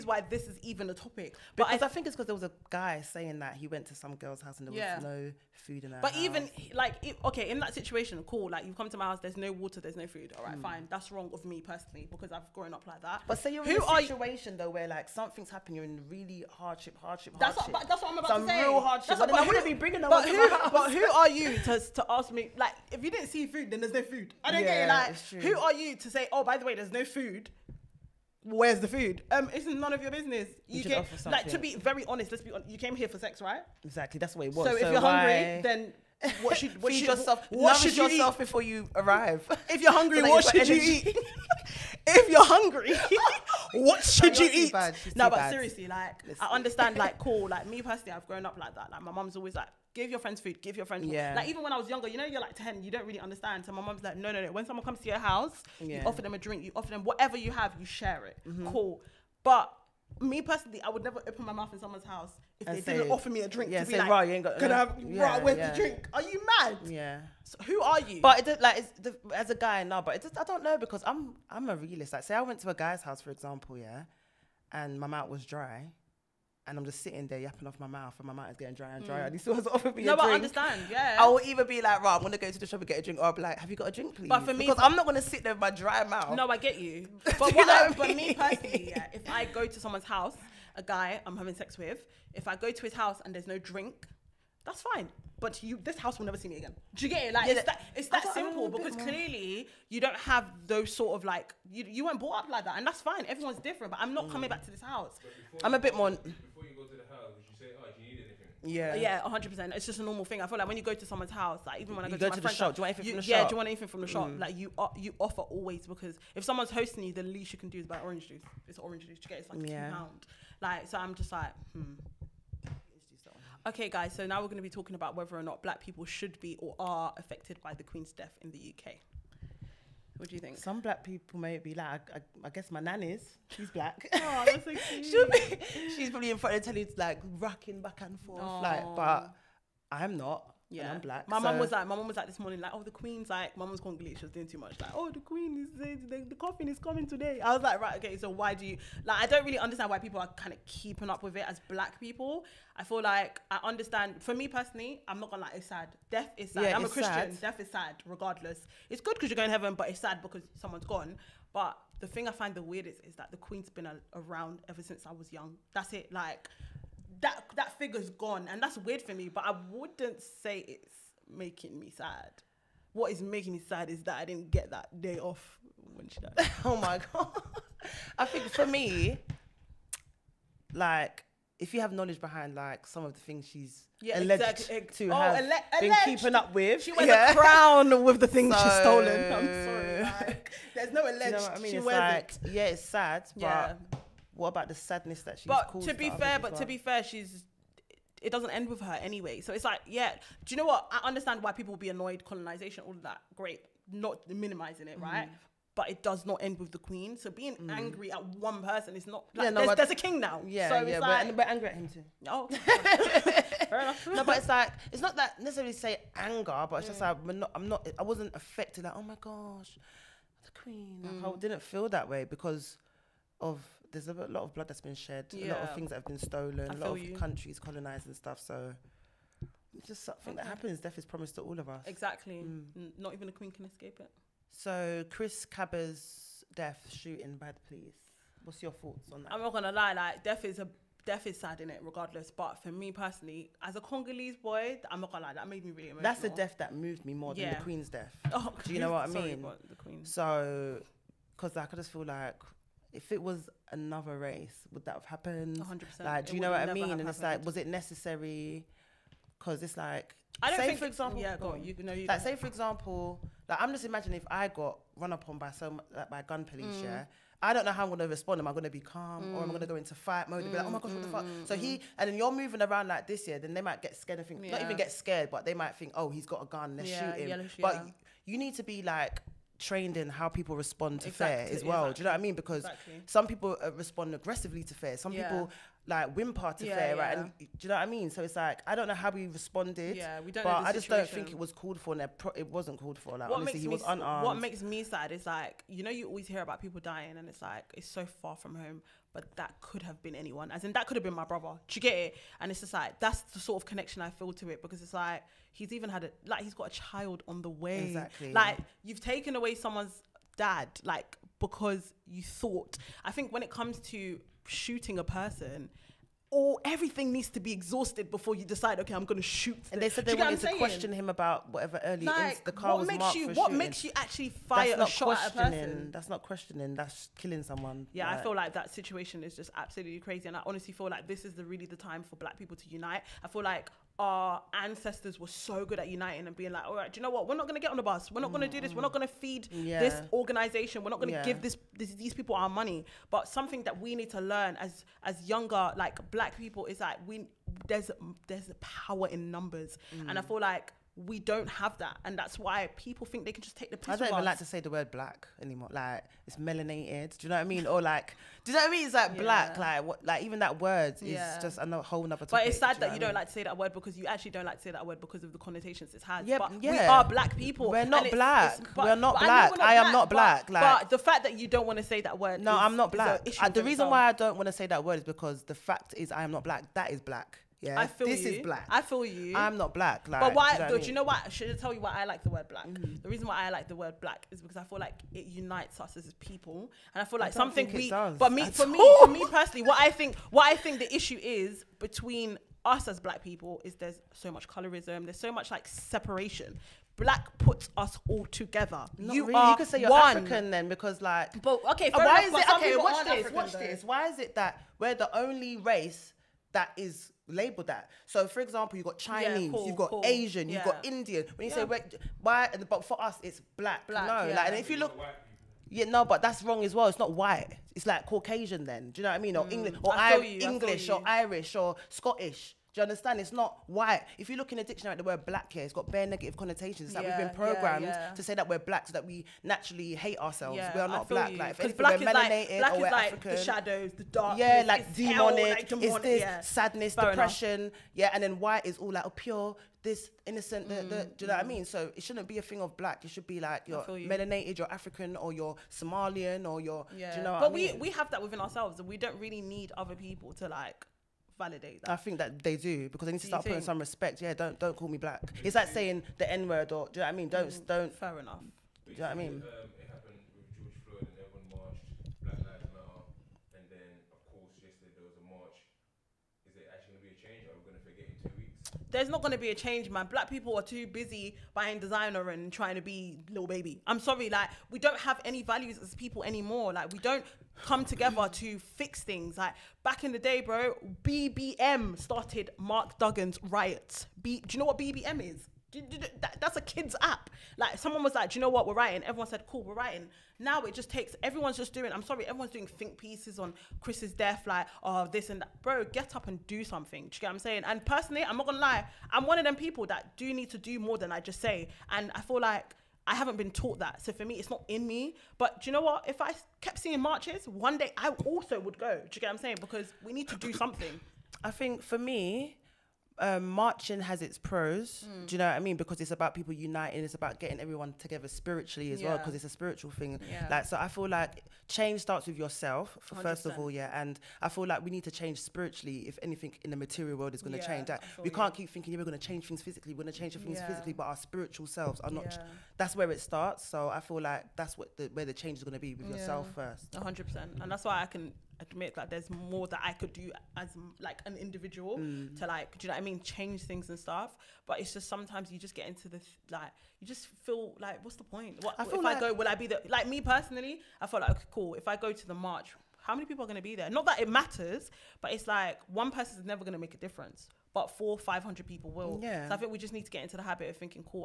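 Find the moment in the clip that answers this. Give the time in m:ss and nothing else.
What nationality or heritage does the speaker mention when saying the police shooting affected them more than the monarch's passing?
4:03.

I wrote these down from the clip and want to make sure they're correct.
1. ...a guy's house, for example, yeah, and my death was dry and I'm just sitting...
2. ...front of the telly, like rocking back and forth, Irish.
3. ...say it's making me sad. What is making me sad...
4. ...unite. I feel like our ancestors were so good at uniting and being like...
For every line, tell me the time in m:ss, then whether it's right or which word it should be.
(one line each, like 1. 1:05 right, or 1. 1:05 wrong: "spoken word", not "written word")
1. 1:12 wrong: "mouth", not "death"
2. 2:16 wrong: "Aww", not "Irish"
3. 2:50 right
4. 5:32 right.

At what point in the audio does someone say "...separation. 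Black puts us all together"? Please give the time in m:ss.
6:35.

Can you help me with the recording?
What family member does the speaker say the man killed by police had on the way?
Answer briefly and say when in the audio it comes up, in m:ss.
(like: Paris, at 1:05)
child, at 5:06.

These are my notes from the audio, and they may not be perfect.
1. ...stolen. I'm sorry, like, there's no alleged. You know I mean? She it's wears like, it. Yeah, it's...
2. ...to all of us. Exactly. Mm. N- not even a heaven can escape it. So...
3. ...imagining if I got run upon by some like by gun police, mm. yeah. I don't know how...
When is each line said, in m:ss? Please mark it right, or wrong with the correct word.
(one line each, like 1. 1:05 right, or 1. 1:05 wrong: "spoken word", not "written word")
1. 3:08 right
2. 3:51 wrong: "queen", not "heaven"
3. 4:23 right.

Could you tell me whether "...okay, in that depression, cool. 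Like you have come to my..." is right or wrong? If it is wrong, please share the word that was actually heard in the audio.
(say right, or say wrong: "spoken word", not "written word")
wrong: "situation", not "depression".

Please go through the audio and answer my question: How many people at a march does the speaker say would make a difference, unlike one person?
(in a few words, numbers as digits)
500.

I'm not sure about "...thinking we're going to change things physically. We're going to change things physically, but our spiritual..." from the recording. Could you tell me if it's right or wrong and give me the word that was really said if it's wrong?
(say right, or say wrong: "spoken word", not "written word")
right.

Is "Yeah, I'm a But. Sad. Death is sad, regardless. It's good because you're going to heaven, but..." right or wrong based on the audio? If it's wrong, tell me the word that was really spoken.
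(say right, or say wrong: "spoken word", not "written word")
wrong: "Christian", not "But".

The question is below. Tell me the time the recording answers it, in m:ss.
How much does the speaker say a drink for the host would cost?
1:59.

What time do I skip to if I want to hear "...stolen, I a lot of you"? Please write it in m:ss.
3:46.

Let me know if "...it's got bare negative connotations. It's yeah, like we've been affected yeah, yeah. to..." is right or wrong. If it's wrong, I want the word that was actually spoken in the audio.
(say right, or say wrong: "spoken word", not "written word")
wrong: "programmed", not "affected".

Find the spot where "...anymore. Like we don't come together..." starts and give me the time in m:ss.
7:56.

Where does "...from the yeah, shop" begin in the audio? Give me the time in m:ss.
1:53.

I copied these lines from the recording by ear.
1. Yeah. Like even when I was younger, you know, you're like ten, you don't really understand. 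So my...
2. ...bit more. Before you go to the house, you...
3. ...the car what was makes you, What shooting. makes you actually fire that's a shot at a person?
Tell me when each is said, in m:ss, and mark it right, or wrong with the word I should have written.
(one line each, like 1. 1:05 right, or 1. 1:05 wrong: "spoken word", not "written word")
1. 0:51 right
2. 1:45 right
3. 5:22 right.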